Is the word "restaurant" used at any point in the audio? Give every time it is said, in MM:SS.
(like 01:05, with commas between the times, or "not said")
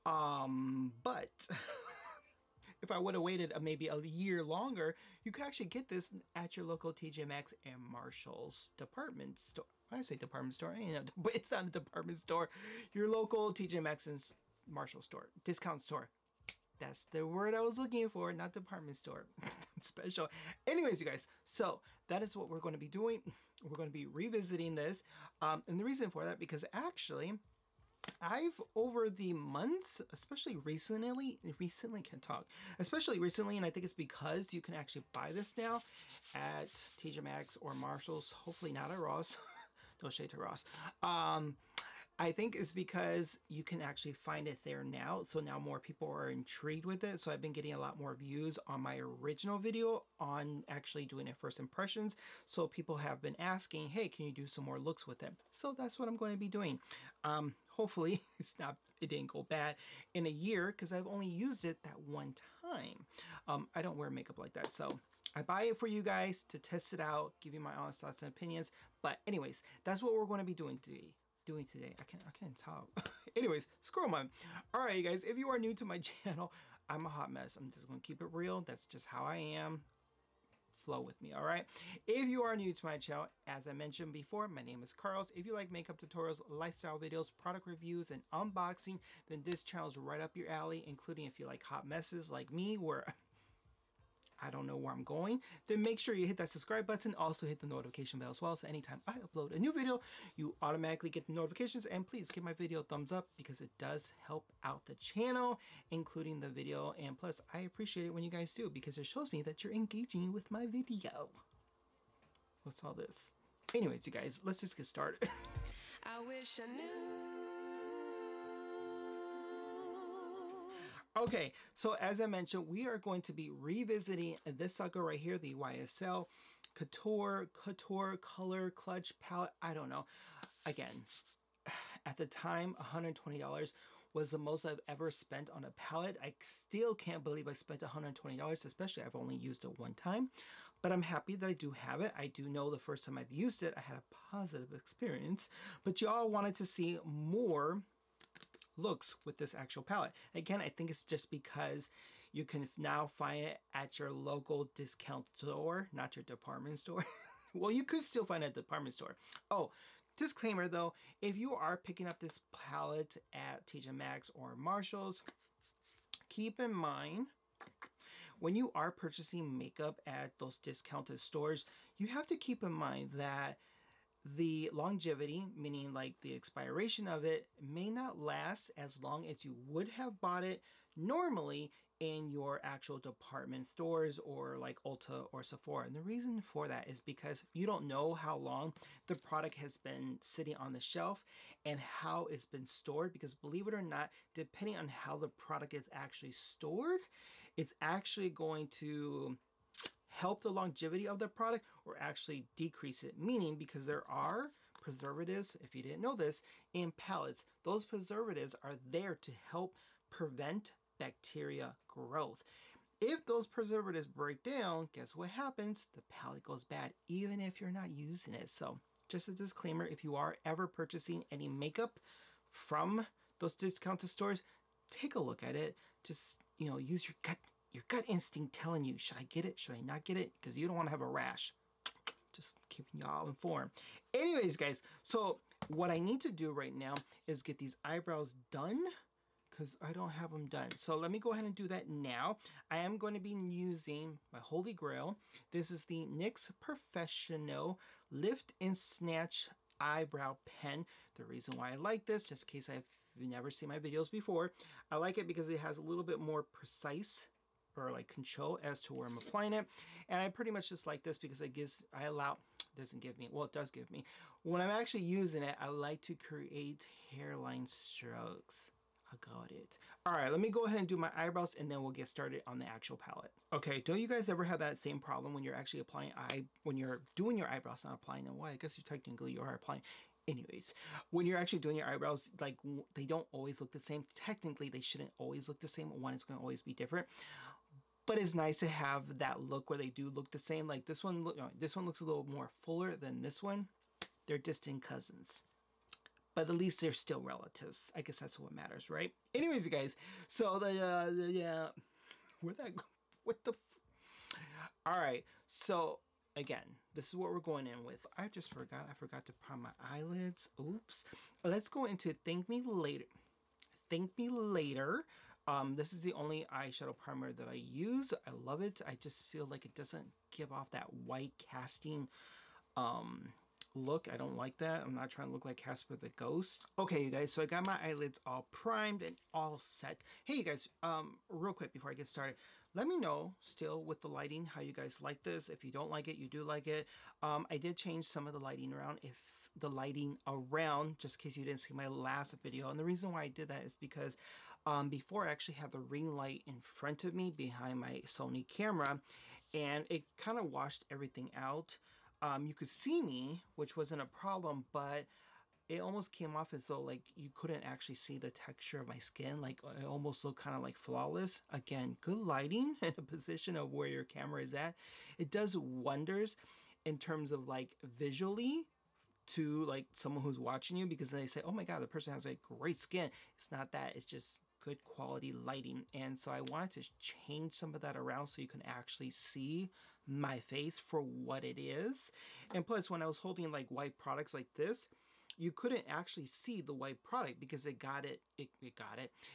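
not said.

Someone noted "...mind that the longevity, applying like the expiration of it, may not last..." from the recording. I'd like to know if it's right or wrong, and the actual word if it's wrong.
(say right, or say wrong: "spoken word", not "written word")
wrong: "meaning", not "applying".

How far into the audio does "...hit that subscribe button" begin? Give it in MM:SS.
01:36.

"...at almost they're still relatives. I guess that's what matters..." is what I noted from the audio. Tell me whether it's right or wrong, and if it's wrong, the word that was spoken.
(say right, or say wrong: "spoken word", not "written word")
wrong: "least", not "almost".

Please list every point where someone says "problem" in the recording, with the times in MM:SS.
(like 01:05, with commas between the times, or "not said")
04:34, 05:54.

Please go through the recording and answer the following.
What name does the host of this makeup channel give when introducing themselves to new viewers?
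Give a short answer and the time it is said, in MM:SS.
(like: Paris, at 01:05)
Carlos, at 01:24.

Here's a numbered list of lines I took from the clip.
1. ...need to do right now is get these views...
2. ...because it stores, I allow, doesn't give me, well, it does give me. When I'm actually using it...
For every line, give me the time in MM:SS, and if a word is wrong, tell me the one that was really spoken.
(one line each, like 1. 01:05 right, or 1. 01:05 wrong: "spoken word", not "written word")
1. 03:55 wrong: "eyebrows", not "views"
2. 04:21 wrong: "gives", not "stores".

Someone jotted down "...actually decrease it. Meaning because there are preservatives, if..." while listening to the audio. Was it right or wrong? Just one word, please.
right.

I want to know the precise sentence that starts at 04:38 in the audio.
why I guess you technically you are applying.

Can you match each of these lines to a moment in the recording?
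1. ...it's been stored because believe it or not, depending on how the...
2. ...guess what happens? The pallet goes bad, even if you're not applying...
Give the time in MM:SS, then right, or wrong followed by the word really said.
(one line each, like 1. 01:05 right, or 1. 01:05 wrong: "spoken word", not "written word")
1. 03:12 right
2. 03:34 wrong: "using", not "applying".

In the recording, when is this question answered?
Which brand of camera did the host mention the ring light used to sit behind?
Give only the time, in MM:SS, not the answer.
05:48.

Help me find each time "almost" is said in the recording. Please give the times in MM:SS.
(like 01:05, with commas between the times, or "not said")
05:55, 05:59.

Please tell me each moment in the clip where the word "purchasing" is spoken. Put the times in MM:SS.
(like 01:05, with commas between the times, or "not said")
02:48, 03:40.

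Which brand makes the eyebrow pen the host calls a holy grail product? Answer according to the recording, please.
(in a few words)
NYX.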